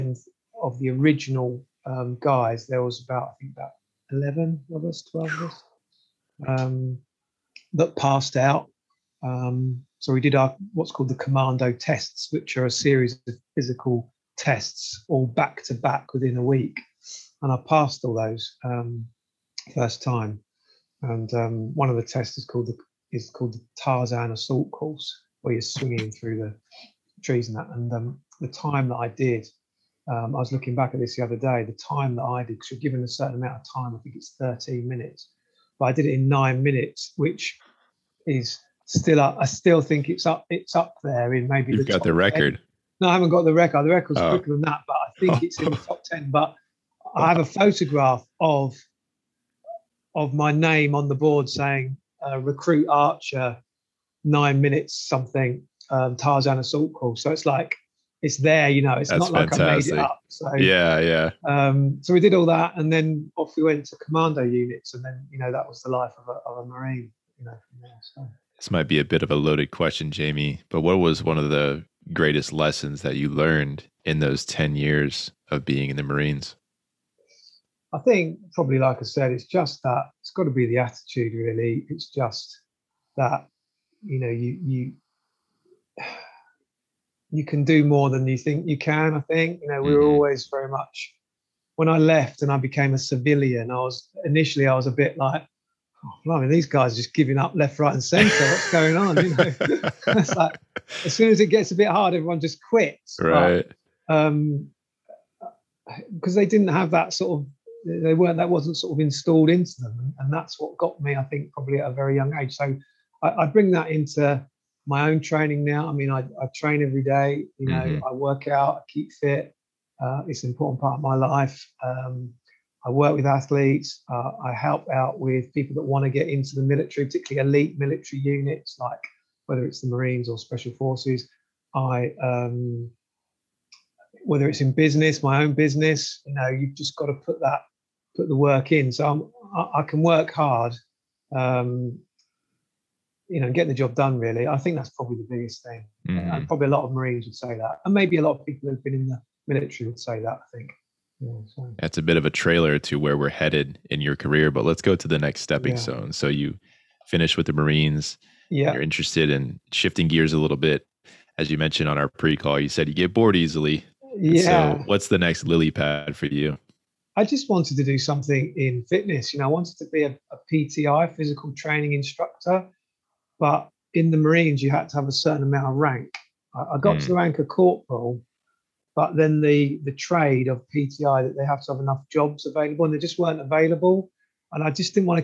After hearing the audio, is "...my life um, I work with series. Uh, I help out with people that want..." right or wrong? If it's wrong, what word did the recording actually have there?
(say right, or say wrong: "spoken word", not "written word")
wrong: "athletes", not "series".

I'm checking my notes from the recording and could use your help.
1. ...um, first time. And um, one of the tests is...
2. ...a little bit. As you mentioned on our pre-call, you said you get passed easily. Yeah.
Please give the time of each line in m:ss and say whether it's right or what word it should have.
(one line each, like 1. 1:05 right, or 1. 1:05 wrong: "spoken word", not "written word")
1. 0:18 right
2. 2:40 wrong: "bored", not "passed".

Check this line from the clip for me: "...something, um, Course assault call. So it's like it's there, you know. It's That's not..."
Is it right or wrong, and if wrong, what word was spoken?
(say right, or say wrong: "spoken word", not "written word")
wrong: "Tarzan", not "Course".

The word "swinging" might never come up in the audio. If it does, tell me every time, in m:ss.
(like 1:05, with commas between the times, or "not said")
0:25.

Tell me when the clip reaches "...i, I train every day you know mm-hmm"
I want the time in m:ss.
1:56.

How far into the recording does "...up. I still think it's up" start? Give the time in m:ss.
0:39.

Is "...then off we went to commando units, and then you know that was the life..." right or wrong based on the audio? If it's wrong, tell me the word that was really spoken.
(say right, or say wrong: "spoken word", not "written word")
right.